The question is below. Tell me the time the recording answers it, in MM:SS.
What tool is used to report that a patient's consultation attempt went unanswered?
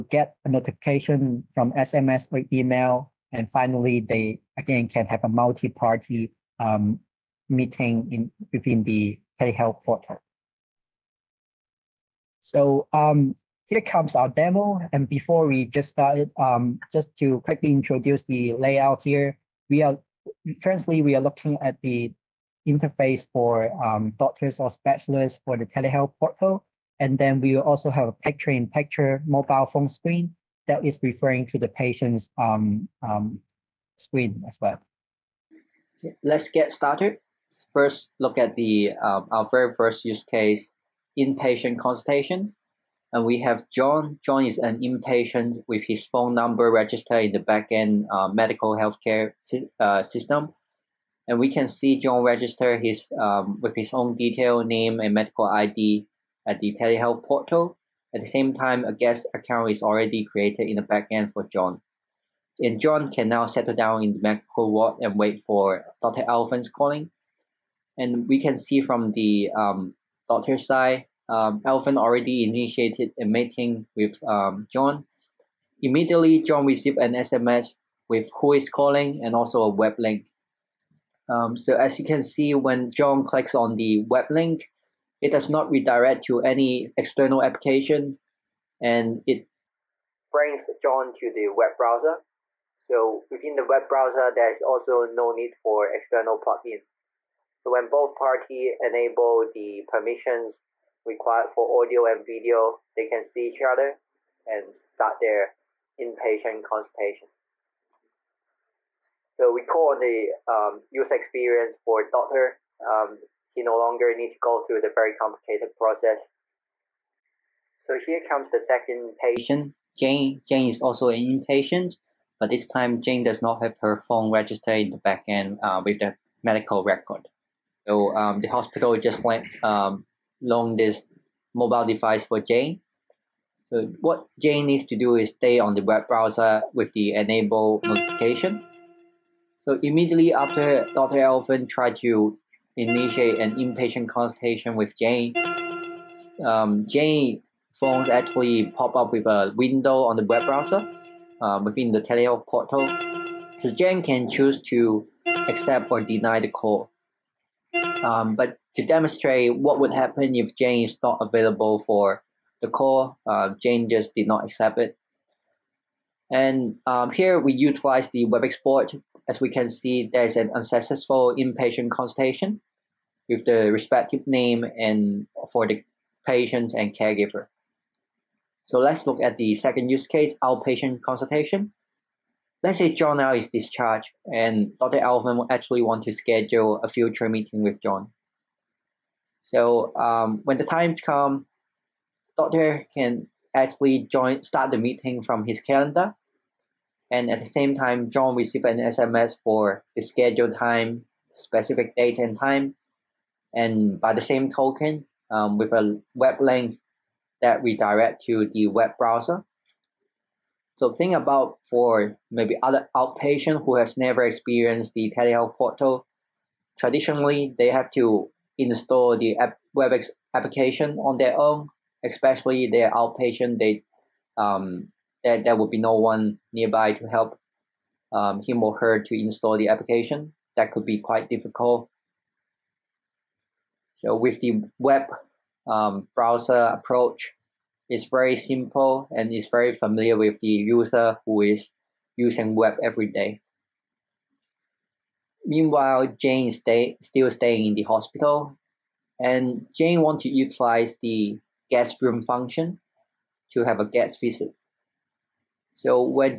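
02:48.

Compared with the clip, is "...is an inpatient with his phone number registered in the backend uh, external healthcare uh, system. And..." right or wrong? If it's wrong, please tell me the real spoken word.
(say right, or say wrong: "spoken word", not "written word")
wrong: "medical", not "external".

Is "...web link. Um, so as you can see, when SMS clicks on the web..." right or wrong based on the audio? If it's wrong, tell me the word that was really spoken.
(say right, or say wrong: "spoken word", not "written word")
wrong: "John", not "SMS".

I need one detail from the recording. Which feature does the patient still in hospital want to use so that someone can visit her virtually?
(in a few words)
Guest room function.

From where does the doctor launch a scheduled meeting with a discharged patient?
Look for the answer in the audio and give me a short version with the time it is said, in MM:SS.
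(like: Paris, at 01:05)
His calendar, at 03:15.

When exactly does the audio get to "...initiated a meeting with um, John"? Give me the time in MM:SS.
01:12.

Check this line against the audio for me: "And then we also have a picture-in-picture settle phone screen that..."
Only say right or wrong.
wrong.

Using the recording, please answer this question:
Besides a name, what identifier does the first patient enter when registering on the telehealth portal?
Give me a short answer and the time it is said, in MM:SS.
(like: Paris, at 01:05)
Medical ID, at 00:55.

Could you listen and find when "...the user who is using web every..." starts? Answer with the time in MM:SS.
04:00.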